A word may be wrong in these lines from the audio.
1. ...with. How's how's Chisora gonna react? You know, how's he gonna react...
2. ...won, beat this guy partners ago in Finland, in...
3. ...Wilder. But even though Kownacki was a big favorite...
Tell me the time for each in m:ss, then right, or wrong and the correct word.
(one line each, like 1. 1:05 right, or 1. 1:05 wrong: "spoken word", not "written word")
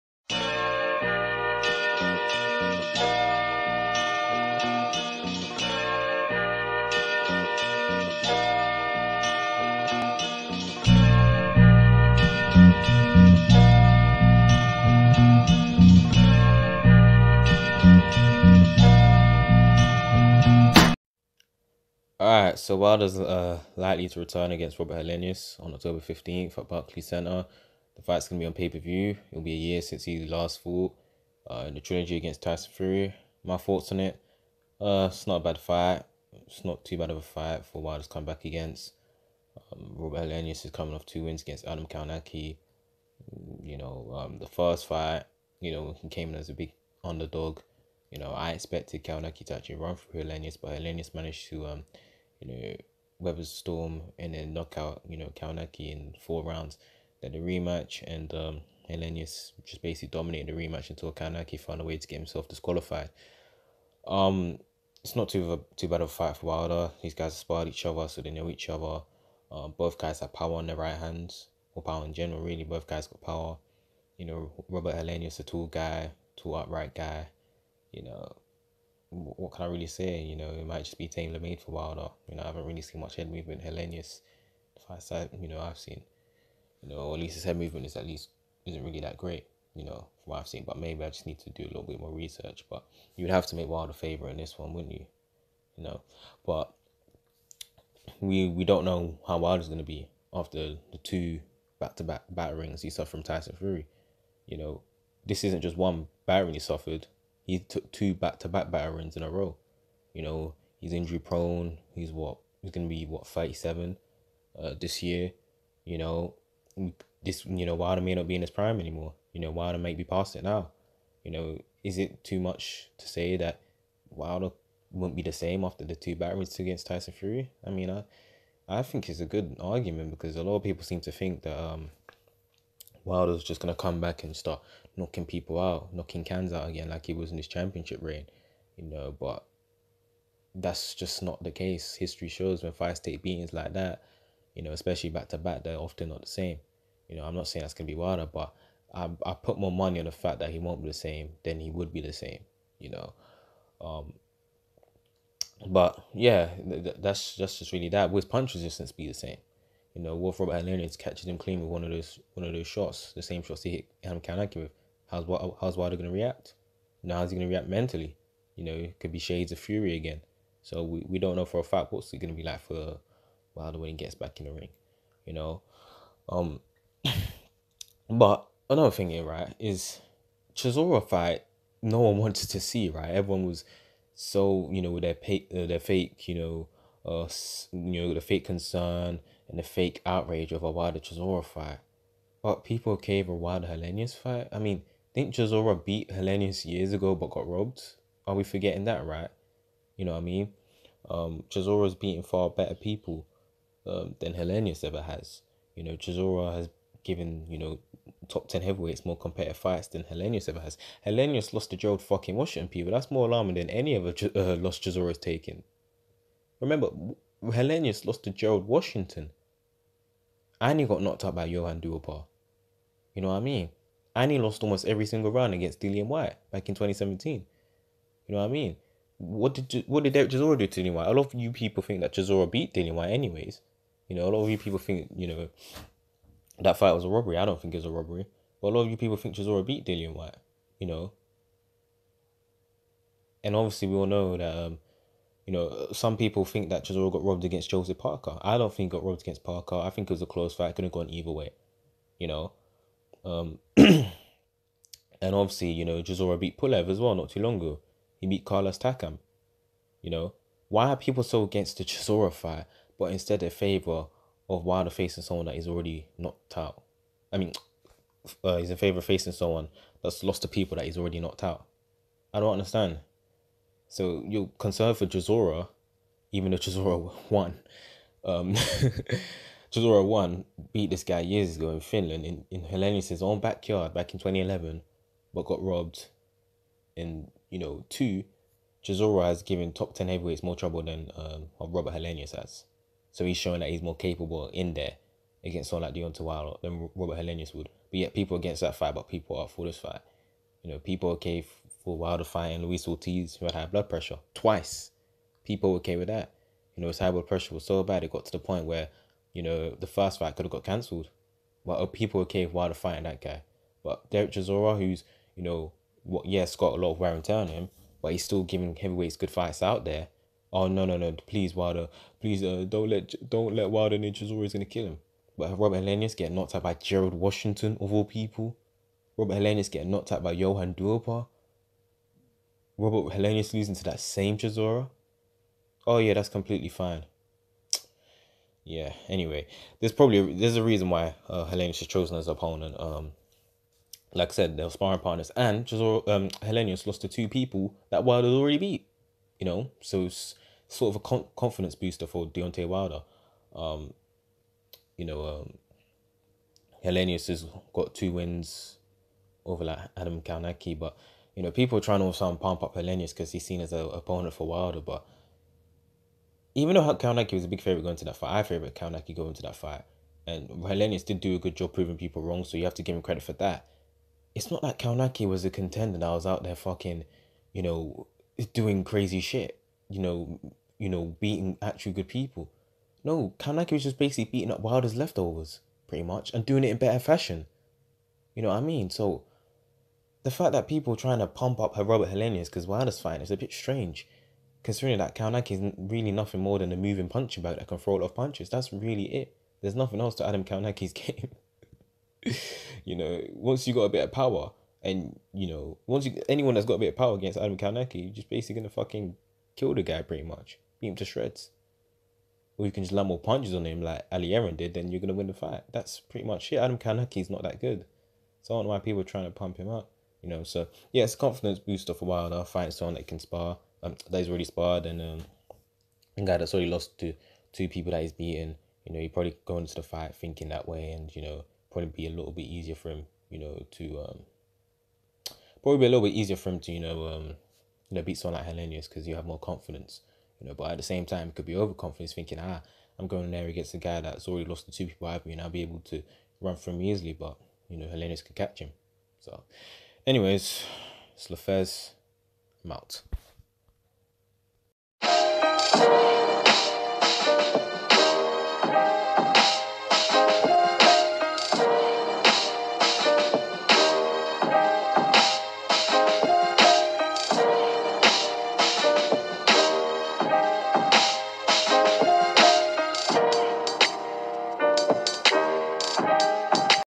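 1. 2:44 wrong: "Wilder", not "Chisora"
2. 4:39 wrong: "years", not "partners"
3. 6:04 right.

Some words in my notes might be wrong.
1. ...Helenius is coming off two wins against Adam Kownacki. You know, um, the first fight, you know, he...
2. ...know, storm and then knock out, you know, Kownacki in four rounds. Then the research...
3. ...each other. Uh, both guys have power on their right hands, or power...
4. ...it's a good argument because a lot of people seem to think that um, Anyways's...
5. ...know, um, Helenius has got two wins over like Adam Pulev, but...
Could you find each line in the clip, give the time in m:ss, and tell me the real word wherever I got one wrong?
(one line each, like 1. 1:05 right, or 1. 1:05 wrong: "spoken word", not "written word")
1. 0:40 right
2. 0:53 wrong: "rematch", not "research"
3. 1:08 right
4. 2:09 wrong: "Wilder", not "Anyways"
5. 5:55 wrong: "Kownacki", not "Pulev".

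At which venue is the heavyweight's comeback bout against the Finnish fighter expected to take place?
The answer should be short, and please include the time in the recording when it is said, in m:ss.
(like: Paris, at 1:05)
Barclays Centre, at 0:26.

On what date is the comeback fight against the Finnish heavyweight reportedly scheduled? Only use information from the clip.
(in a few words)
October 15th.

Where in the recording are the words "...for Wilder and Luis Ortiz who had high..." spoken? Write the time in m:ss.
5:01.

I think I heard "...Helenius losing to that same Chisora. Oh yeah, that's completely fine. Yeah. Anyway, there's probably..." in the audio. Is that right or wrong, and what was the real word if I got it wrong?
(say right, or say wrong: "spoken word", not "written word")
right.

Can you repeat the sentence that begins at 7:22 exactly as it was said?
I'm going there against a guy that's already lost to two people I've been.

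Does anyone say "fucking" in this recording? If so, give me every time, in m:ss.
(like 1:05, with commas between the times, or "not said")
3:32, 6:16, 6:48.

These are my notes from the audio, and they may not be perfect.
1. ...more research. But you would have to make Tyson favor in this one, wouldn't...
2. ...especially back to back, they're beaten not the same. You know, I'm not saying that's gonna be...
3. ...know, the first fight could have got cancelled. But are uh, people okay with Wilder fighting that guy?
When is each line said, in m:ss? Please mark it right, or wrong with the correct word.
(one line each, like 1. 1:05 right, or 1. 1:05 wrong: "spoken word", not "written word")
1. 1:31 wrong: "Wilder", not "Tyson"
2. 2:24 wrong: "often", not "beaten"
3. 5:09 right.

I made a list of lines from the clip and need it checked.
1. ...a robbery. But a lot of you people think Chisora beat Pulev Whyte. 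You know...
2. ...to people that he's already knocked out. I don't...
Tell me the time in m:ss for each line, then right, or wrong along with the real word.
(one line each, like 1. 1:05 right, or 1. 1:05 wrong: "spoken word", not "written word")
1. 3:57 wrong: "Dillian", not "Pulev"
2. 4:30 right.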